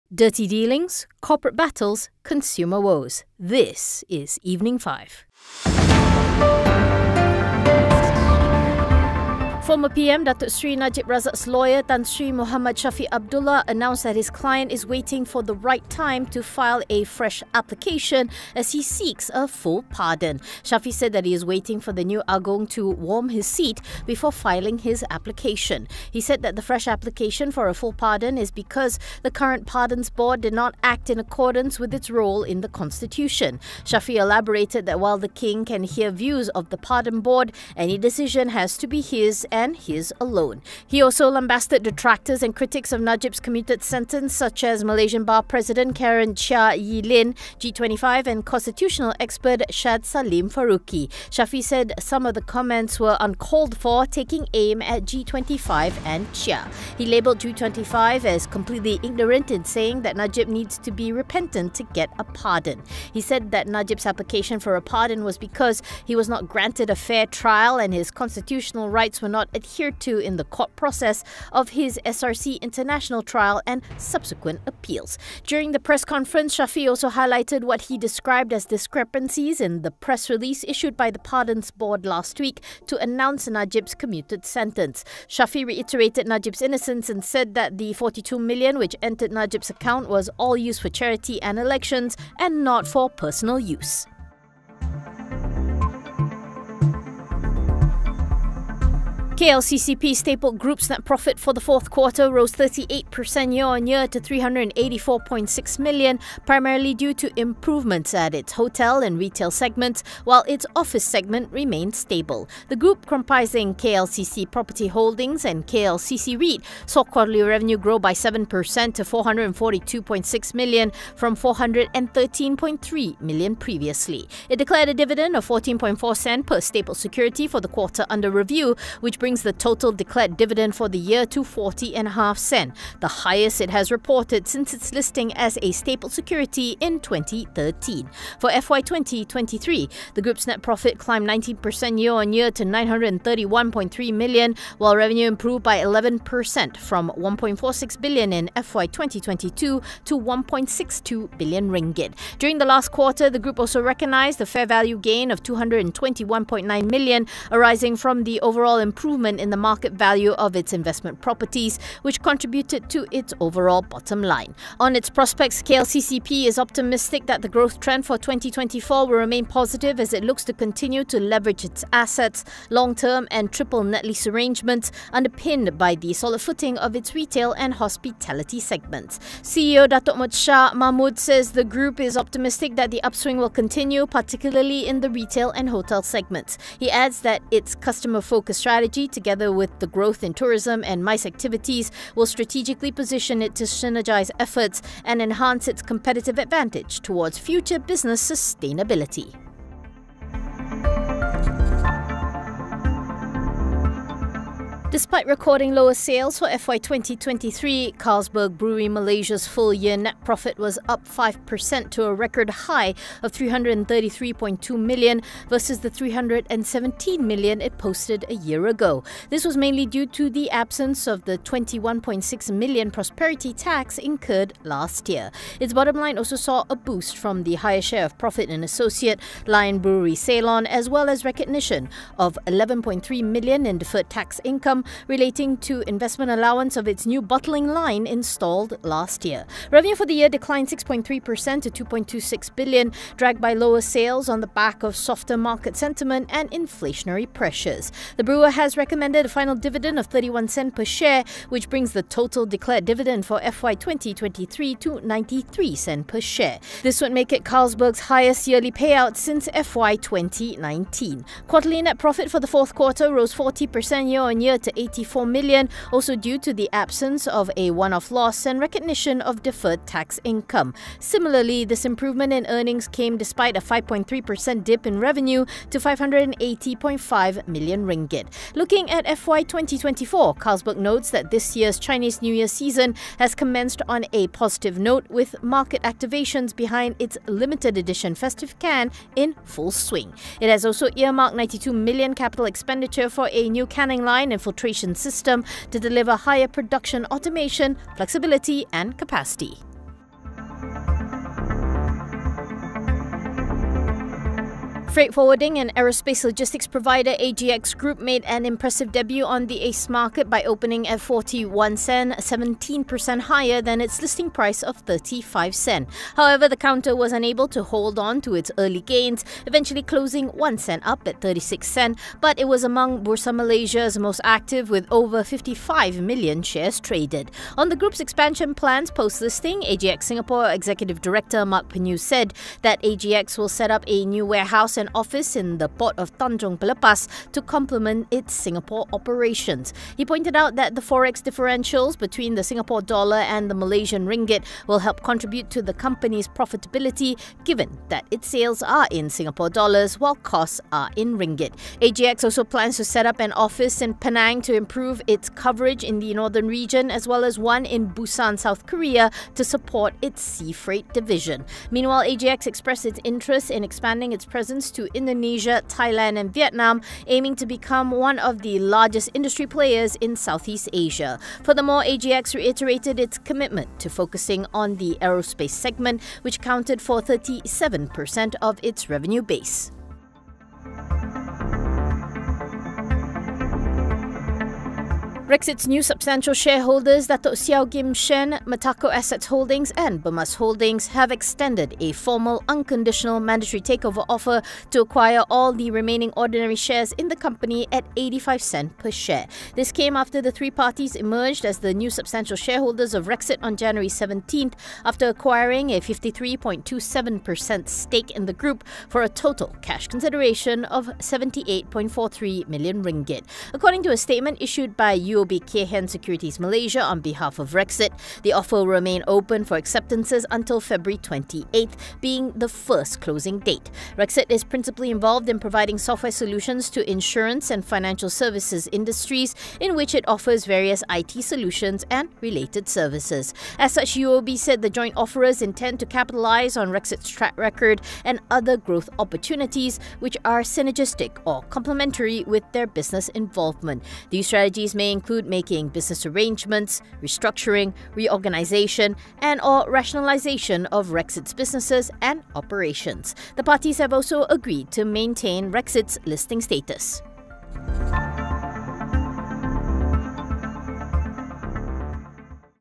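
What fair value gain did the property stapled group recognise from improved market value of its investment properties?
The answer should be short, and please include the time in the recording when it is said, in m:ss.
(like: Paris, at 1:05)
221.9 million, at 2:35.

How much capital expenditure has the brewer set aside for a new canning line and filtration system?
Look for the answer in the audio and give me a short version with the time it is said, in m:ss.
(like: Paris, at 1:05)
92 million, at 4:51.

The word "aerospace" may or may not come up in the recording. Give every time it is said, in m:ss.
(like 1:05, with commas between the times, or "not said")
5:05, 6:15.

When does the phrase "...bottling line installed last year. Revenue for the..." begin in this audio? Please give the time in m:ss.
3:57.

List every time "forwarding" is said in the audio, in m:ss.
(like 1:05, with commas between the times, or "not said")
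5:05.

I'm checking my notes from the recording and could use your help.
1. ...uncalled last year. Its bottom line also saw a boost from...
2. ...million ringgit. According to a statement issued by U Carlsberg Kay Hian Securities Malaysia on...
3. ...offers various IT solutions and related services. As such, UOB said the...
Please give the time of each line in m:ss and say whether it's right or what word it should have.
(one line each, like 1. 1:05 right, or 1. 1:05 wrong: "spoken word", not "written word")
1. 3:43 wrong: "incurred", not "uncalled"
2. 6:52 wrong: "UOB", not "Carlsberg"
3. 7:10 right.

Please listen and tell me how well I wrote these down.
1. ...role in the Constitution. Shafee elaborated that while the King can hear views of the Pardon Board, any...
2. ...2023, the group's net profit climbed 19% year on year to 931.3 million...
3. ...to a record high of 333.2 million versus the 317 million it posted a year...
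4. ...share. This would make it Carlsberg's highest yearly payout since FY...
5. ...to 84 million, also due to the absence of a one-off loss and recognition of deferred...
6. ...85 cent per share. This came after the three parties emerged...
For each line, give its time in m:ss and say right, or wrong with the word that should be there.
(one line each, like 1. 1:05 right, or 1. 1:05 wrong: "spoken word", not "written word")
1. 0:32 right
2. 2:18 right
3. 3:31 right
4. 4:16 right
5. 4:24 right
6. 6:37 right.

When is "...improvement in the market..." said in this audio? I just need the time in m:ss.
2:38.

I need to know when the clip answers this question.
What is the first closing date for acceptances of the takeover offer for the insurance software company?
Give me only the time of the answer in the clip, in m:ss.
7:00.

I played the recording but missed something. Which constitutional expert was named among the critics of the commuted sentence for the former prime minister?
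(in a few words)
Shad Saleem Faruqi.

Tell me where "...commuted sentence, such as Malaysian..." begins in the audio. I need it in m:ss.
0:43.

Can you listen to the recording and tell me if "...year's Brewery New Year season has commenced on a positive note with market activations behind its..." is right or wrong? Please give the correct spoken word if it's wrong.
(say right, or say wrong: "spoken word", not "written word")
wrong: "Chinese", not "Brewery".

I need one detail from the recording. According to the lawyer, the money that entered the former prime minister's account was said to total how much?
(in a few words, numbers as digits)
42 million.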